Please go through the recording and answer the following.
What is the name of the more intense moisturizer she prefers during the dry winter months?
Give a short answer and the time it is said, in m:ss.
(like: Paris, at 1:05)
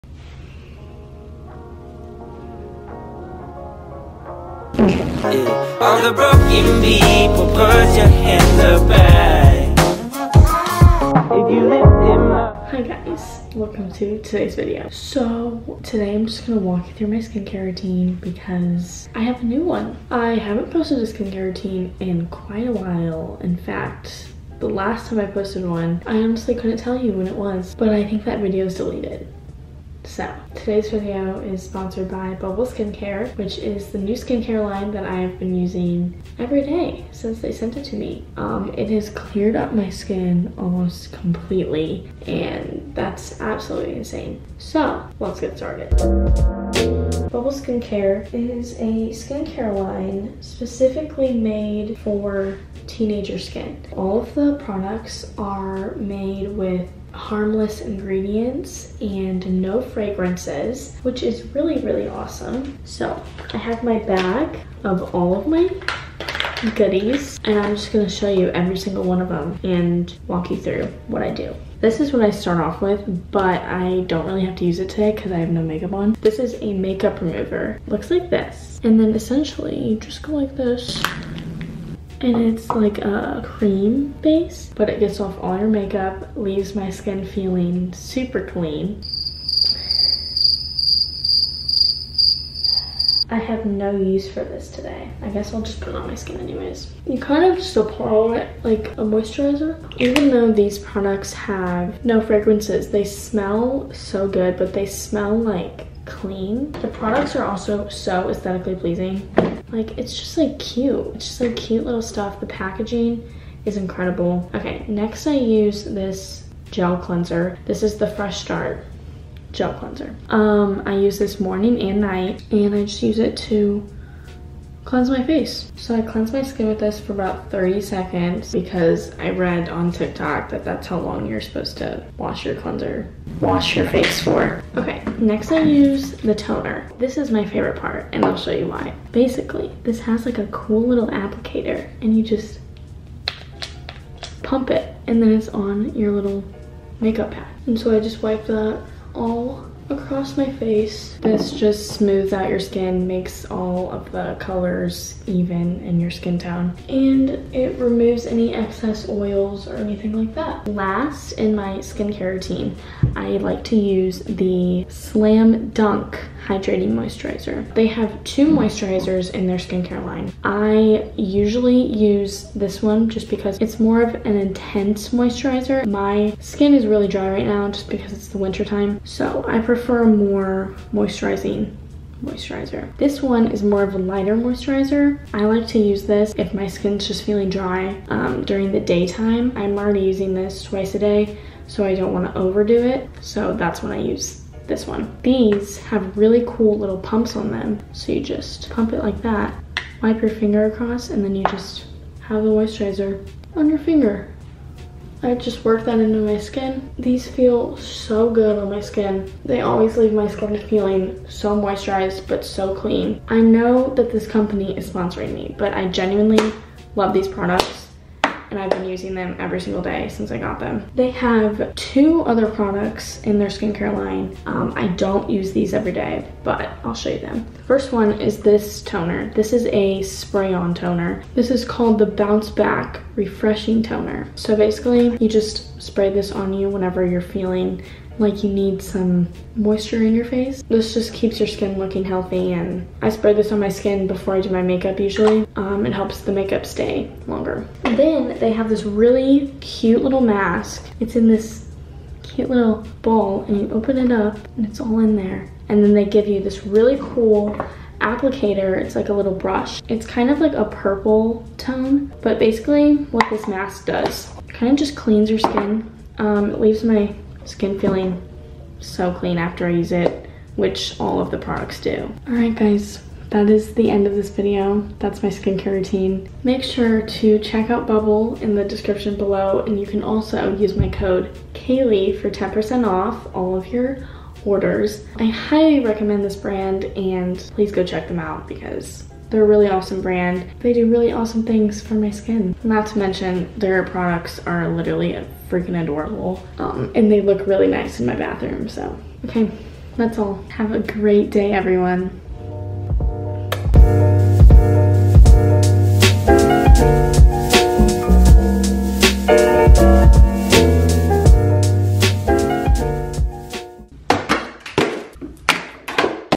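Slam Dunk Hydrating Moisturizer, at 2:44.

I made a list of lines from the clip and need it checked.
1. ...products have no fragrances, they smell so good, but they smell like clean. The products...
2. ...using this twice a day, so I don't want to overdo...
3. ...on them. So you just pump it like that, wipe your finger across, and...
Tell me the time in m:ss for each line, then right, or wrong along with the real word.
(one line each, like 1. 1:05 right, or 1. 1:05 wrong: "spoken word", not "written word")
1. 1:40 right
2. 3:10 right
3. 3:17 right.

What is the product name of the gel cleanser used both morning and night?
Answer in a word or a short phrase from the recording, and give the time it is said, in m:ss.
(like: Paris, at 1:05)
Fresh Start, at 1:58.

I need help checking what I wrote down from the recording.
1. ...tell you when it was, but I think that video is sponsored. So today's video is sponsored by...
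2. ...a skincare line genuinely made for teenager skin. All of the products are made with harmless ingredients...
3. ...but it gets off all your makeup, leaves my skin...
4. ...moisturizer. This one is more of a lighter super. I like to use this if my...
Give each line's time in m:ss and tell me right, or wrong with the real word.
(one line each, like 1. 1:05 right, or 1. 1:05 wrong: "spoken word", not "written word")
1. 0:26 wrong: "deleted", not "sponsored"
2. 0:48 wrong: "specifically", not "genuinely"
3. 1:24 right
4. 3:02 wrong: "moisturizer", not "super".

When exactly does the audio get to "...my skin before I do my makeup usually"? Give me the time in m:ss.
4:03.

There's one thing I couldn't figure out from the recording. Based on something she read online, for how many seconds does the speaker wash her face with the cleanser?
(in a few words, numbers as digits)
30.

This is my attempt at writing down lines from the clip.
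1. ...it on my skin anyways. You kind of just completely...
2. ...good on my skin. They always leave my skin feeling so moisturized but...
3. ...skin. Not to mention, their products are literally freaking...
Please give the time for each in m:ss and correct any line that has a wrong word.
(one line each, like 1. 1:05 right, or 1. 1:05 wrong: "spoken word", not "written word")
1. 1:35 wrong: "apply", not "completely"
2. 3:28 right
3. 4:52 right.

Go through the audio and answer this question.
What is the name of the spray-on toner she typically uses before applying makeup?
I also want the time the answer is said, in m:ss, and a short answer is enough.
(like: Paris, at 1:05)
Bounce Back Refreshing Toner, at 3:52.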